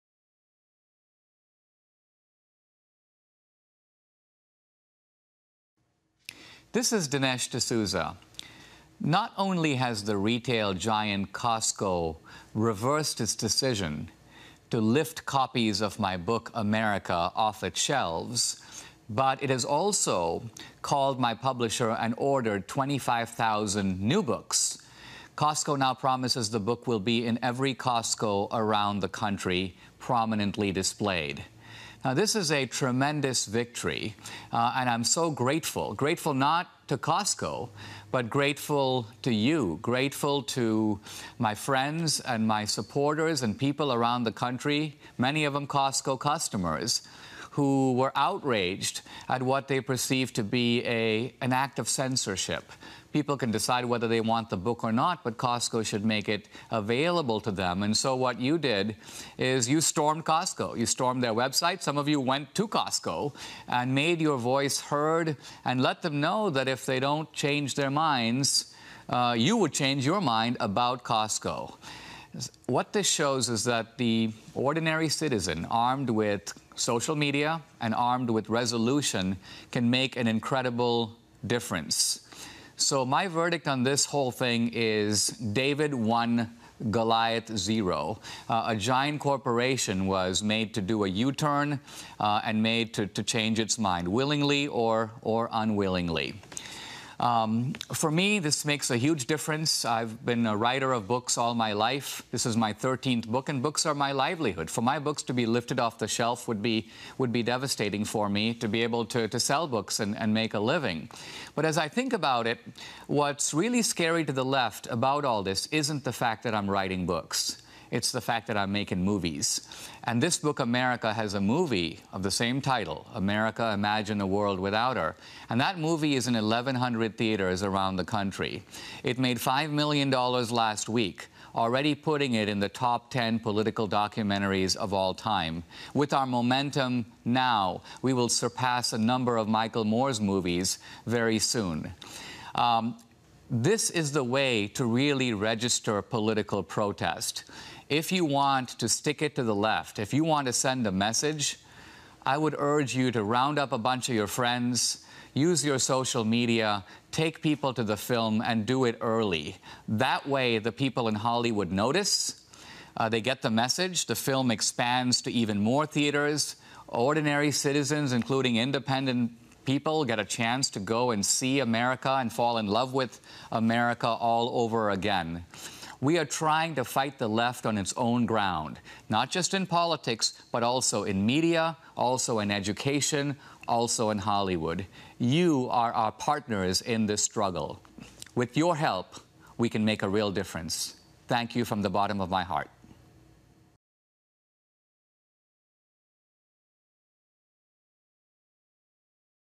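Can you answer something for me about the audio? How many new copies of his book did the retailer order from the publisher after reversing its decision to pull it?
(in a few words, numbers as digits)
25,000.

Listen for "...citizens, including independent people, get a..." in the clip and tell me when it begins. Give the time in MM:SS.
02:47.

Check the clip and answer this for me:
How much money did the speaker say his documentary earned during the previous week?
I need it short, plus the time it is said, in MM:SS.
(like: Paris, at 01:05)
$5 million, at 02:09.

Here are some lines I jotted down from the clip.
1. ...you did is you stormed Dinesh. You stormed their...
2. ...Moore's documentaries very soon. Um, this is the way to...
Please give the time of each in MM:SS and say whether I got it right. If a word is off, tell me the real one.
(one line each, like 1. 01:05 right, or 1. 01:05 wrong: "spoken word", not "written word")
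1. 00:58 wrong: "Costco", not "Dinesh"
2. 02:19 wrong: "movies", not "documentaries".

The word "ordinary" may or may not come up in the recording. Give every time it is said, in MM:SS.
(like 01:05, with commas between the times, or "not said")
01:14, 02:46.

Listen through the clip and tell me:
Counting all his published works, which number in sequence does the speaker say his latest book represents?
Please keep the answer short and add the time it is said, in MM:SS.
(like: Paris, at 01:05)
13th, at 01:42.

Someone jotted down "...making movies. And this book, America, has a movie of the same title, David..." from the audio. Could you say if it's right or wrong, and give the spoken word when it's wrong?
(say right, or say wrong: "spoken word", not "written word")
wrong: "America", not "David".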